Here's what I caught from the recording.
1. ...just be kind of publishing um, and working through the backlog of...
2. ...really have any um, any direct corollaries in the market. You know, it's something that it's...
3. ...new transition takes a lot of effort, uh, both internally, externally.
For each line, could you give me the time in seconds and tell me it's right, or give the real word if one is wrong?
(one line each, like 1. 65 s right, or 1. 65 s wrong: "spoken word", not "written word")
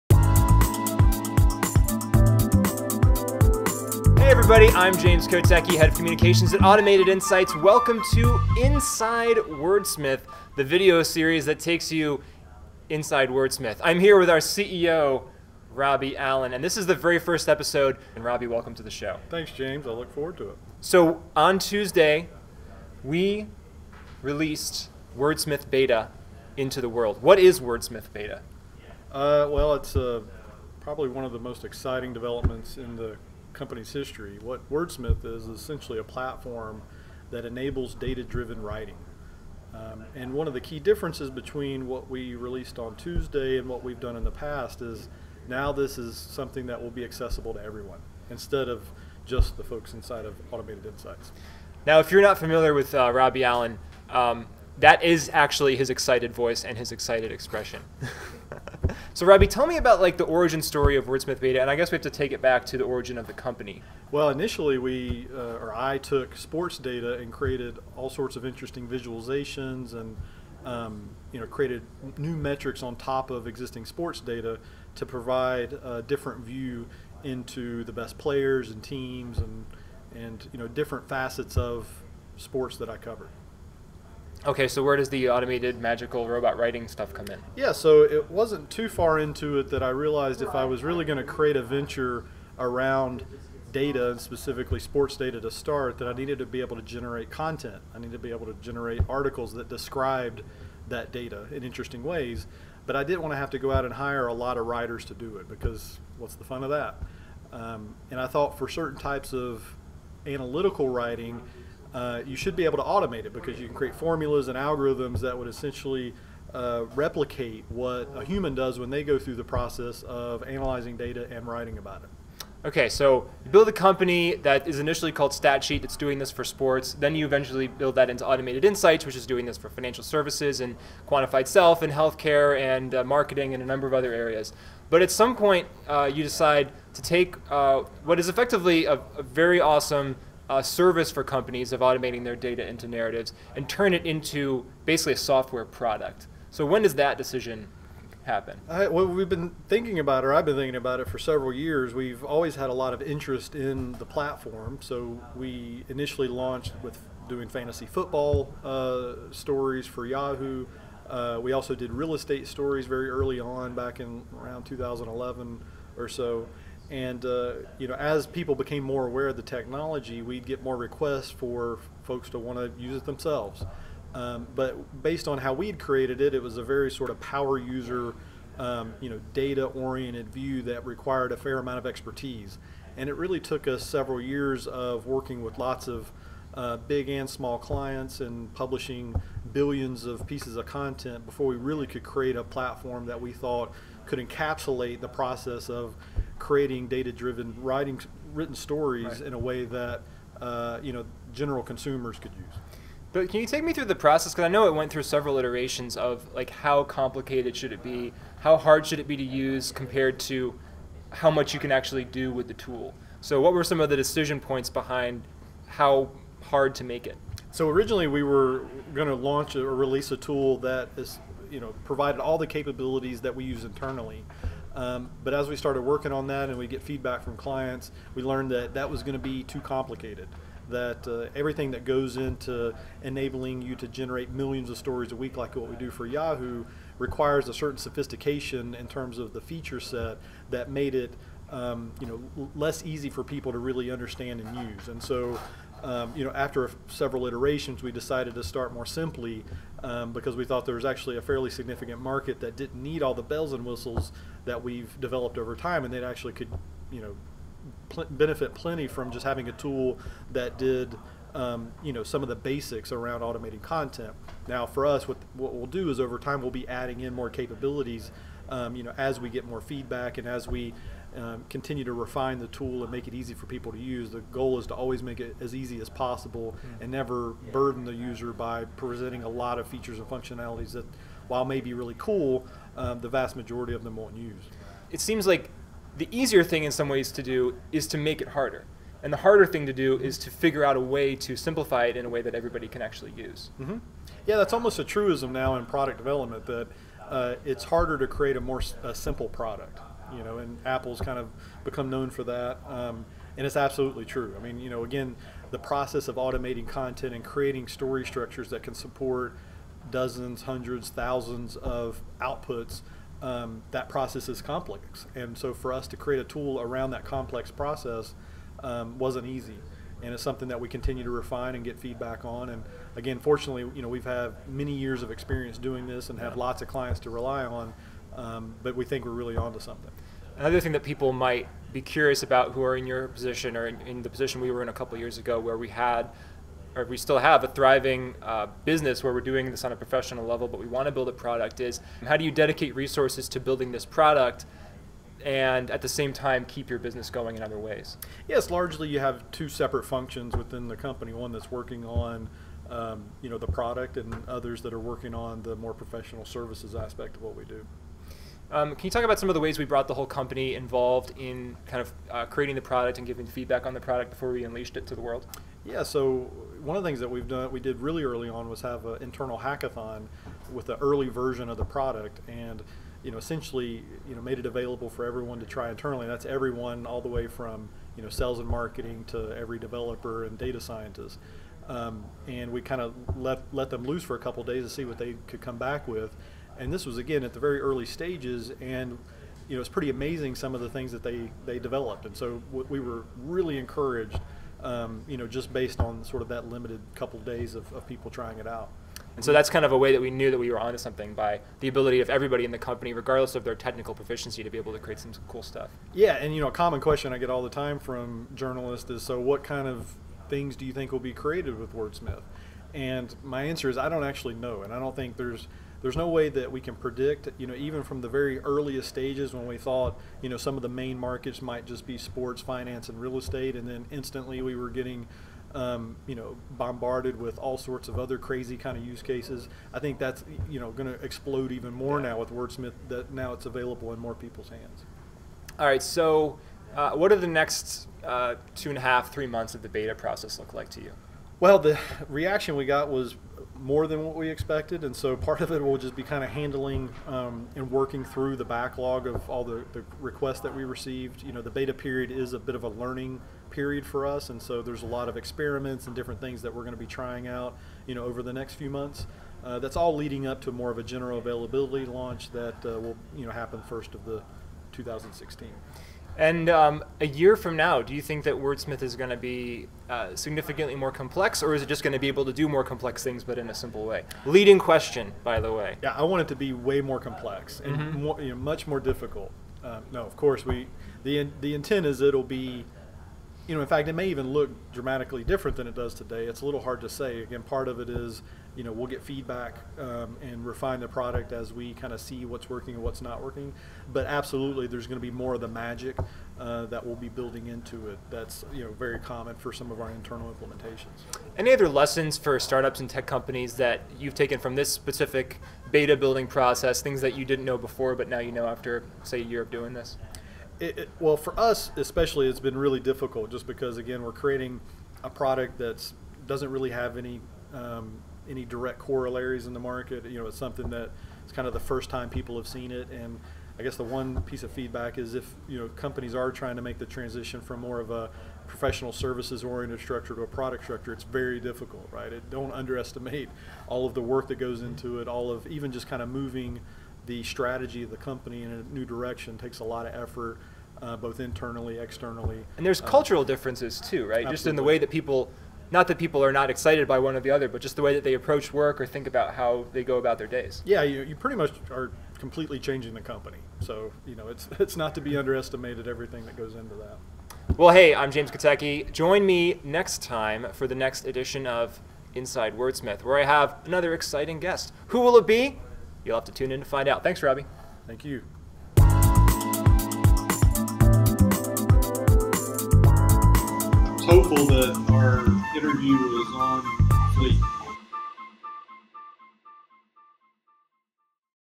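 1. 445 s wrong: "handling", not "publishing"
2. 516 s right
3. 538 s wrong: "direction", not "transition".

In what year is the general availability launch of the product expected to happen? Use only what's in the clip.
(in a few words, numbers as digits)
2016.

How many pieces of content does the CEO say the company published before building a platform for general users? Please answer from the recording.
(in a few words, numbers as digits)
Billions.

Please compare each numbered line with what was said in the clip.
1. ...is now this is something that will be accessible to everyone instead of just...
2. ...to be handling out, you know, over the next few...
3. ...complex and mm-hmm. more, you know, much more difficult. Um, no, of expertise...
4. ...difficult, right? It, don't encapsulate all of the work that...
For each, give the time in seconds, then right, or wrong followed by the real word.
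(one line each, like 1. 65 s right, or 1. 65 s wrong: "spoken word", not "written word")
1. 44 s right
2. 456 s wrong: "trying", not "handling"
3. 476 s wrong: "course", not "expertise"
4. 531 s wrong: "underestimate", not "encapsulate".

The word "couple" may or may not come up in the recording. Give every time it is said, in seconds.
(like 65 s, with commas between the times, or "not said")
334 s, 384 s, 396 s.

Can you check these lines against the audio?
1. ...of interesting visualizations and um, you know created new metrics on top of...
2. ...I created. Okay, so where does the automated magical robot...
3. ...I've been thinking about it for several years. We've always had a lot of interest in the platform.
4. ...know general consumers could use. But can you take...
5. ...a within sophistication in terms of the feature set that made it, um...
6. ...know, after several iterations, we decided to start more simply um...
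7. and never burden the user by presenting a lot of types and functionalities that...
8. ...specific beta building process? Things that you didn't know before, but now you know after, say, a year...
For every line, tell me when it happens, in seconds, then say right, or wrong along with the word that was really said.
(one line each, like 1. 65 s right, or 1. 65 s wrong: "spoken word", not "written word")
1. 68 s right
2. 82 s wrong: "covered", not "created"
3. 150 s right
4. 200 s right
5. 237 s wrong: "certain", not "within"
6. 246 s right
7. 276 s wrong: "features", not "types"
8. 504 s right.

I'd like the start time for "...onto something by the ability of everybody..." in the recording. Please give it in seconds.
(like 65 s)
400 s.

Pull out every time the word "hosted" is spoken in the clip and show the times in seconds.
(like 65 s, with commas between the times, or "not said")
not said.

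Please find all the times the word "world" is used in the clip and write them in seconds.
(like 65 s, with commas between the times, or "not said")
26 s, 364 s.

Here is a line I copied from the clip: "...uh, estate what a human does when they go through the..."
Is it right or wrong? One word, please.
wrong.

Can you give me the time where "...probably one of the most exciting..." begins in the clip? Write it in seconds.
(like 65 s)
30 s.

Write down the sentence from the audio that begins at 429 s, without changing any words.
I think that's, you know, going to explode even more yeah.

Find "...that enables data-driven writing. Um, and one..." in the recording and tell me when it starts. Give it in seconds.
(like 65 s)
37 s.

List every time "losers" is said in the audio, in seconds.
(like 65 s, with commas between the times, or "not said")
not said.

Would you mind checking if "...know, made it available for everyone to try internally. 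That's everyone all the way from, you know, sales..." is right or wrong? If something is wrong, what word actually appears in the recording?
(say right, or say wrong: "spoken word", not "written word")
right.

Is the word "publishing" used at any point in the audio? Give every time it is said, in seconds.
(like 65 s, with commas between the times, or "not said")
188 s.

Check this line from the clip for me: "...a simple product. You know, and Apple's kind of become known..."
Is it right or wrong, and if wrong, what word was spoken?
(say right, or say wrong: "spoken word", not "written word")
right.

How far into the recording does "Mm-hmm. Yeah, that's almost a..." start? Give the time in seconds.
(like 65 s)
293 s.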